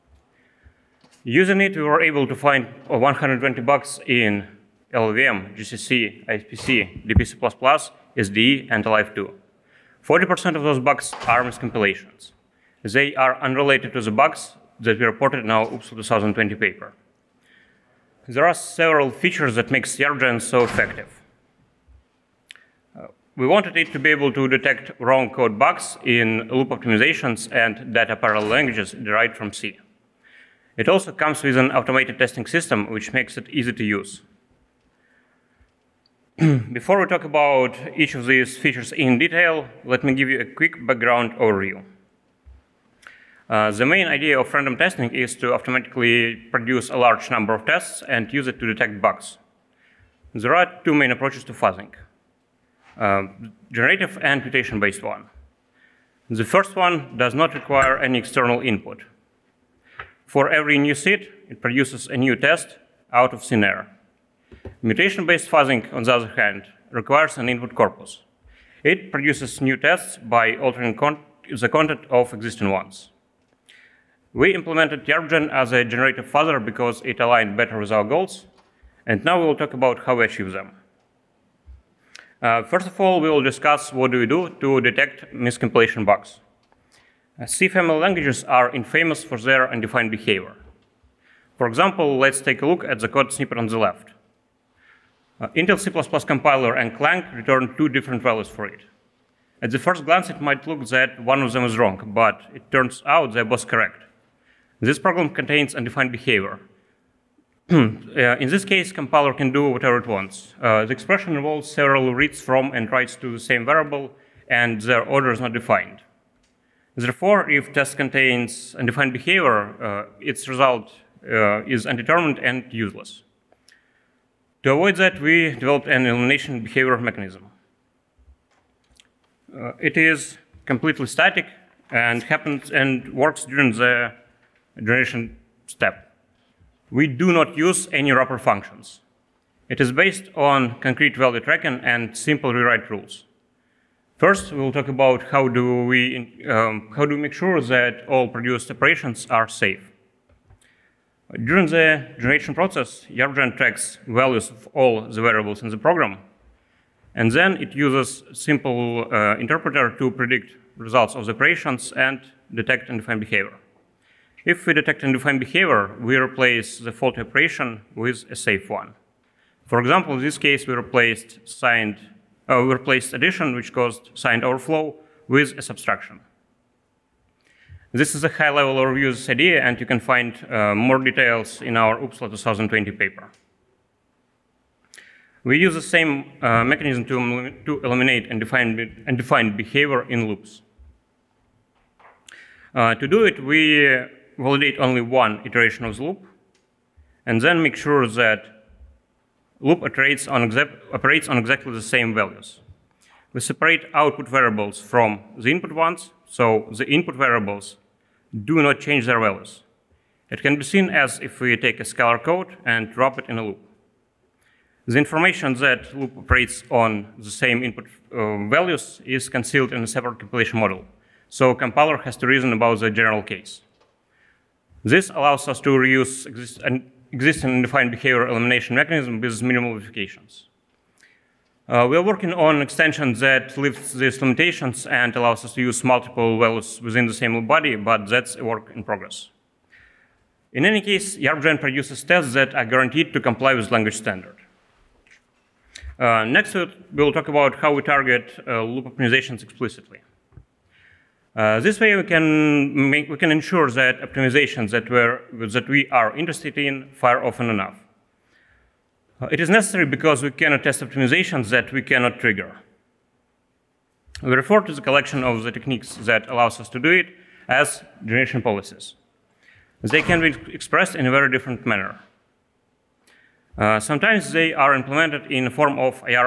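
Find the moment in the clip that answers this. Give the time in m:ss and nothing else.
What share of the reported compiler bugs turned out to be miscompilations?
0:10.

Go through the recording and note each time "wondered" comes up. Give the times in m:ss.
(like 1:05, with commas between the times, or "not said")
not said.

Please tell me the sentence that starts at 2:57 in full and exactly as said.
This is a high-level overview of this idea, and you can find uh, more details in our OOPSLA 2020 paper.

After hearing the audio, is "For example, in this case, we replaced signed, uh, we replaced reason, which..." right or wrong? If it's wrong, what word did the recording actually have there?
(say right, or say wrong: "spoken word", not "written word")
wrong: "addition", not "reason".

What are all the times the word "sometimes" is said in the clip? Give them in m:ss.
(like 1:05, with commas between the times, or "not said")
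4:33.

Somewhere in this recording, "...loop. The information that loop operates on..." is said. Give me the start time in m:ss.
3:33.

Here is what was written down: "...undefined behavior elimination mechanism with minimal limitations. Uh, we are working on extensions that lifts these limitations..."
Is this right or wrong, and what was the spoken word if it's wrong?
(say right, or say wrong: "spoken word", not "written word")
wrong: "modifications", not "limitations".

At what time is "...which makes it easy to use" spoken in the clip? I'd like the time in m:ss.
0:32.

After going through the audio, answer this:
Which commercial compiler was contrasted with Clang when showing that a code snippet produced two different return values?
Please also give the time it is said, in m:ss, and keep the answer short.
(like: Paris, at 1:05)
Intel C++ compiler, at 1:35.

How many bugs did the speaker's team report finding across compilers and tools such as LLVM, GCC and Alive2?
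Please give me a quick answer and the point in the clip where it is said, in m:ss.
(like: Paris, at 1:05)
120, at 0:02.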